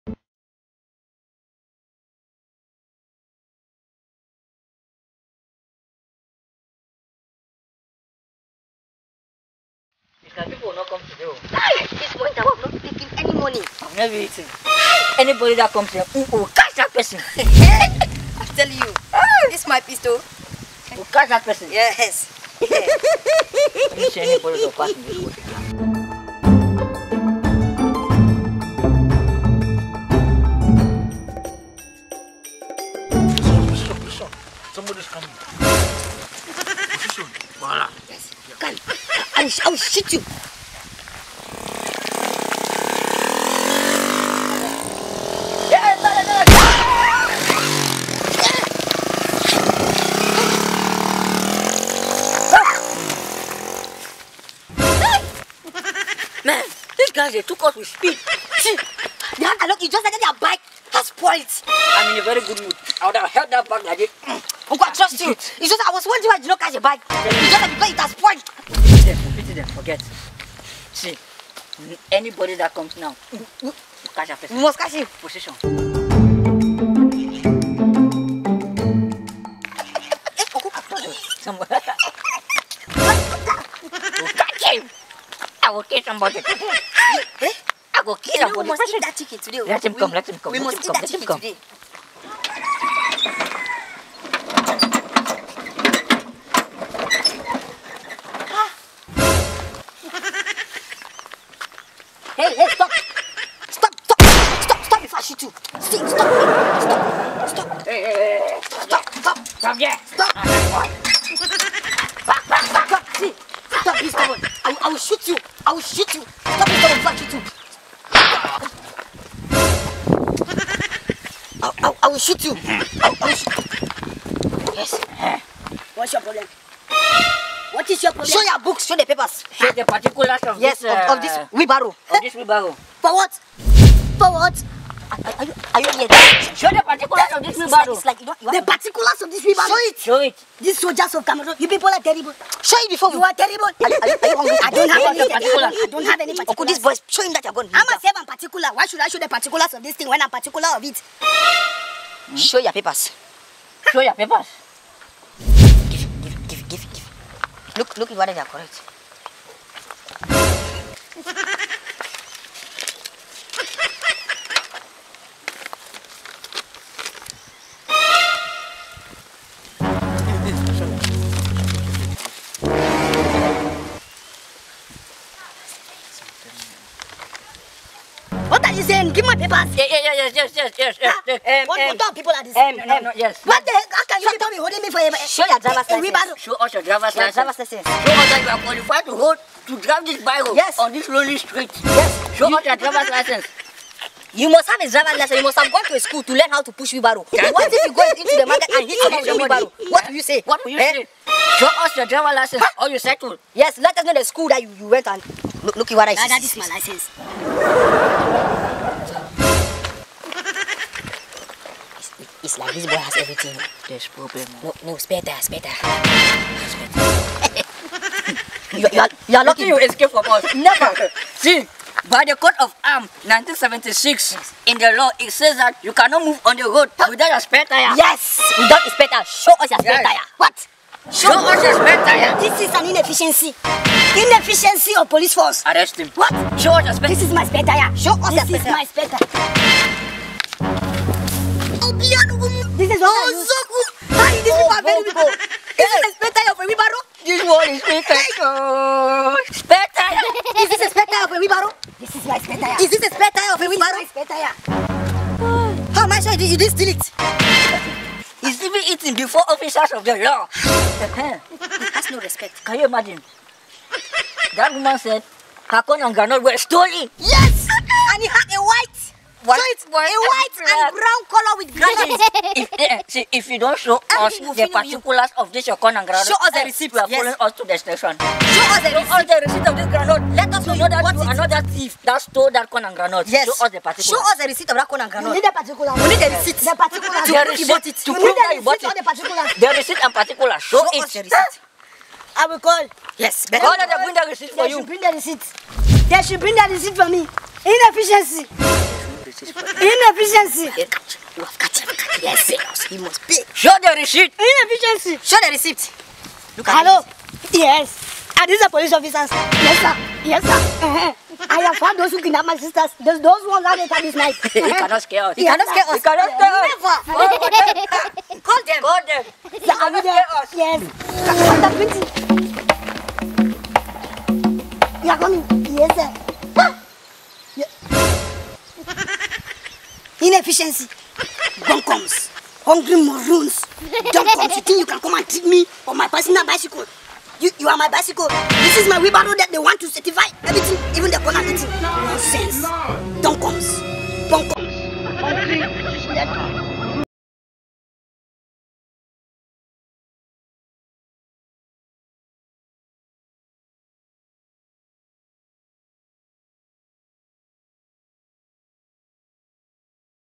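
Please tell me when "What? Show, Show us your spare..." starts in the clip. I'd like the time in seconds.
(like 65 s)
230 s.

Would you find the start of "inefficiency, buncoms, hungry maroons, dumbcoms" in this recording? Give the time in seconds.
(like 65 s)
330 s.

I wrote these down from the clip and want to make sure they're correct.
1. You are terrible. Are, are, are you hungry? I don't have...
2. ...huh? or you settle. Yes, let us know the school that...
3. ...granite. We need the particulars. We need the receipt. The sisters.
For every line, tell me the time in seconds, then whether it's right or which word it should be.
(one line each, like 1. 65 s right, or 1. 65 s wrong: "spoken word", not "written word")
1. 143 s right
2. 202 s right
3. 285 s wrong: "particulars", not "sisters".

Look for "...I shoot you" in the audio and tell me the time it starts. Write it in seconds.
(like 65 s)
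105 s.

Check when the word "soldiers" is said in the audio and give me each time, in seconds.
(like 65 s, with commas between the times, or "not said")
140 s.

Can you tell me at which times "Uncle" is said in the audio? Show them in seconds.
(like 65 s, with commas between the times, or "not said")
64 s.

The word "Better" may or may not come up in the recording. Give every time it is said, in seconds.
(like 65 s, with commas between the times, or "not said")
293 s.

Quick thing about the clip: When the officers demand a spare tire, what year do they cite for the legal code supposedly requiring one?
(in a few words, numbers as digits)
1976.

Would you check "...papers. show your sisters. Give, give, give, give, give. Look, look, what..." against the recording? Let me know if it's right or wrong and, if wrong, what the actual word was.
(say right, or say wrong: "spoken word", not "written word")
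wrong: "papers", not "sisters".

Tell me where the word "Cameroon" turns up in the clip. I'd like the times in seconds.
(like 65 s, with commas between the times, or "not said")
141 s.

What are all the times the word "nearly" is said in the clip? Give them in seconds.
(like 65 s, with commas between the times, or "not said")
not said.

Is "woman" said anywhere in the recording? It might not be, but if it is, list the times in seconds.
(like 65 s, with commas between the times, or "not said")
264 s.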